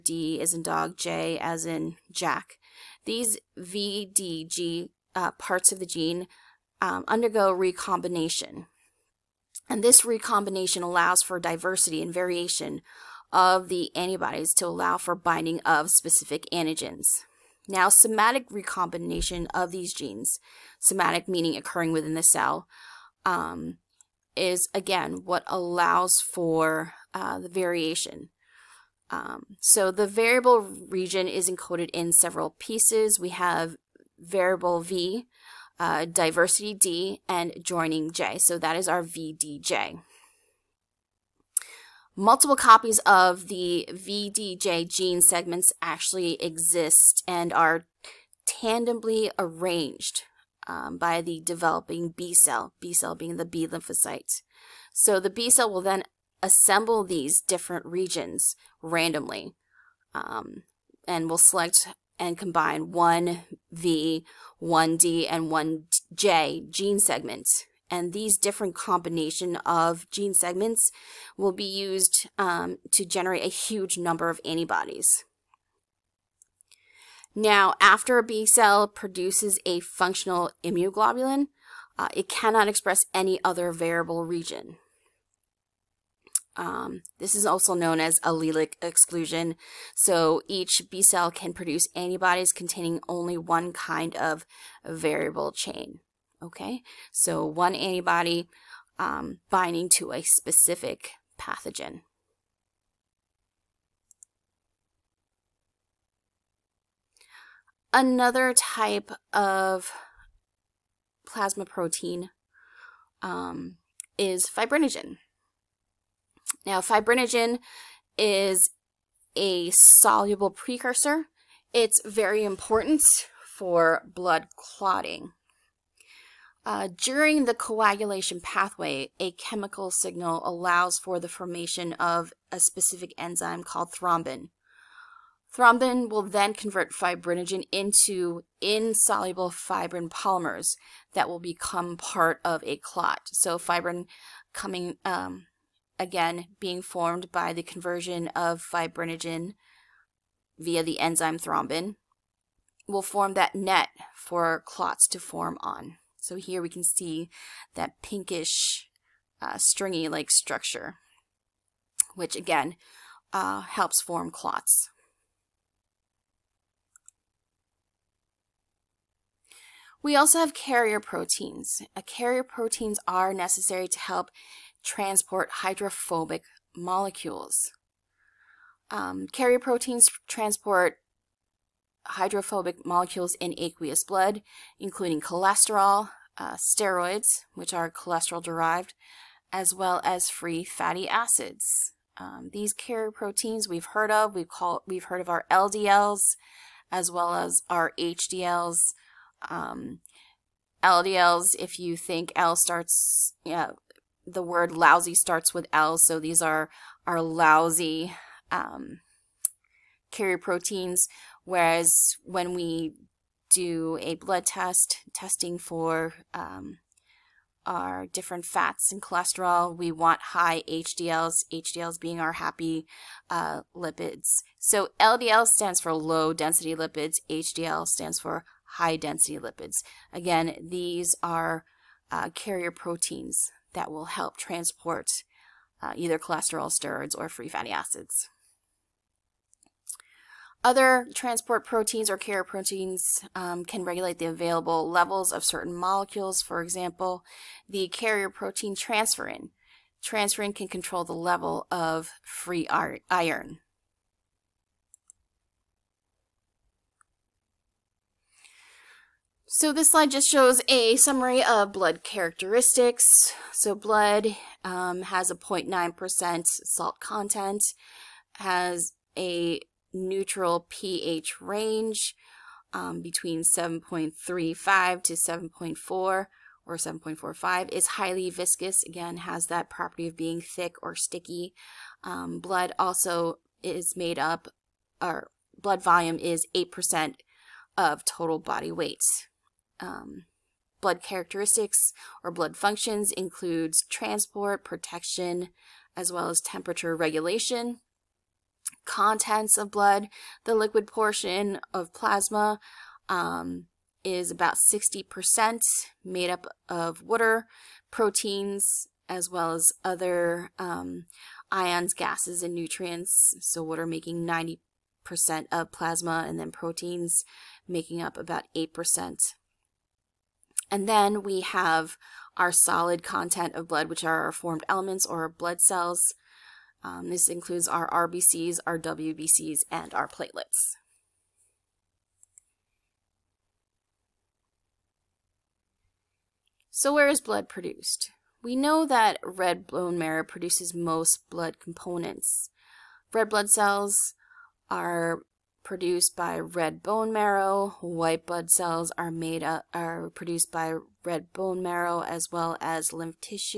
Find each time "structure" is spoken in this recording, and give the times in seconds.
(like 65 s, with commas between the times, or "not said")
160 s.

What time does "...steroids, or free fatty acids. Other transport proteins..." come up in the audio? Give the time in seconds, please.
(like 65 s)
236 s.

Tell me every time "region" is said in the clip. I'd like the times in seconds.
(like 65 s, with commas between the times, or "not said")
30 s, 57 s, 84 s.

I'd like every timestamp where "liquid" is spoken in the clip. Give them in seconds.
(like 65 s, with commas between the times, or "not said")
300 s.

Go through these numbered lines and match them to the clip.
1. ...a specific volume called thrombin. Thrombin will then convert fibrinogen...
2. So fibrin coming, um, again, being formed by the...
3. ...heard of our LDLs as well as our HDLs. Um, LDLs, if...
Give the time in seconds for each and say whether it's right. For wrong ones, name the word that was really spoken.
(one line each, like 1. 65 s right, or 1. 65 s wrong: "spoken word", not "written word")
1. 132 s wrong: "enzyme", not "volume"
2. 143 s right
3. 195 s right.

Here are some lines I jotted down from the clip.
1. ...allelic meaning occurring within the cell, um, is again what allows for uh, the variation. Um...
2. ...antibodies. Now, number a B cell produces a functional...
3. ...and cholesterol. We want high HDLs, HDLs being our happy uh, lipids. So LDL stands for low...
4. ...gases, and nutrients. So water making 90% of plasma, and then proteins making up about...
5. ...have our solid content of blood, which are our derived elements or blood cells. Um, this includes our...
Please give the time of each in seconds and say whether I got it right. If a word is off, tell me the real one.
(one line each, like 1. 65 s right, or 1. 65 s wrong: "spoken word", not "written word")
1. 20 s wrong: "somatic", not "allelic"
2. 74 s wrong: "after", not "number"
3. 218 s right
4. 311 s right
5. 321 s wrong: "formed", not "derived".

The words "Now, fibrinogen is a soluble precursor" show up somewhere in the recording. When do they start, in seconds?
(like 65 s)
116 s.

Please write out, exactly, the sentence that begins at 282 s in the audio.
Um, blood also is made up, or blood volume is 8% of total body weight.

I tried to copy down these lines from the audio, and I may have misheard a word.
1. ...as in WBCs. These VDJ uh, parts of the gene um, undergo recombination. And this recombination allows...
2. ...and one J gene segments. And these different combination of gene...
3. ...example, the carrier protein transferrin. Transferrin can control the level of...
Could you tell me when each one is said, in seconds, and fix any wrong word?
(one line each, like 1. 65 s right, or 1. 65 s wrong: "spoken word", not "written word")
1. 1 s wrong: "Jack", not "WBCs"
2. 65 s right
3. 246 s right.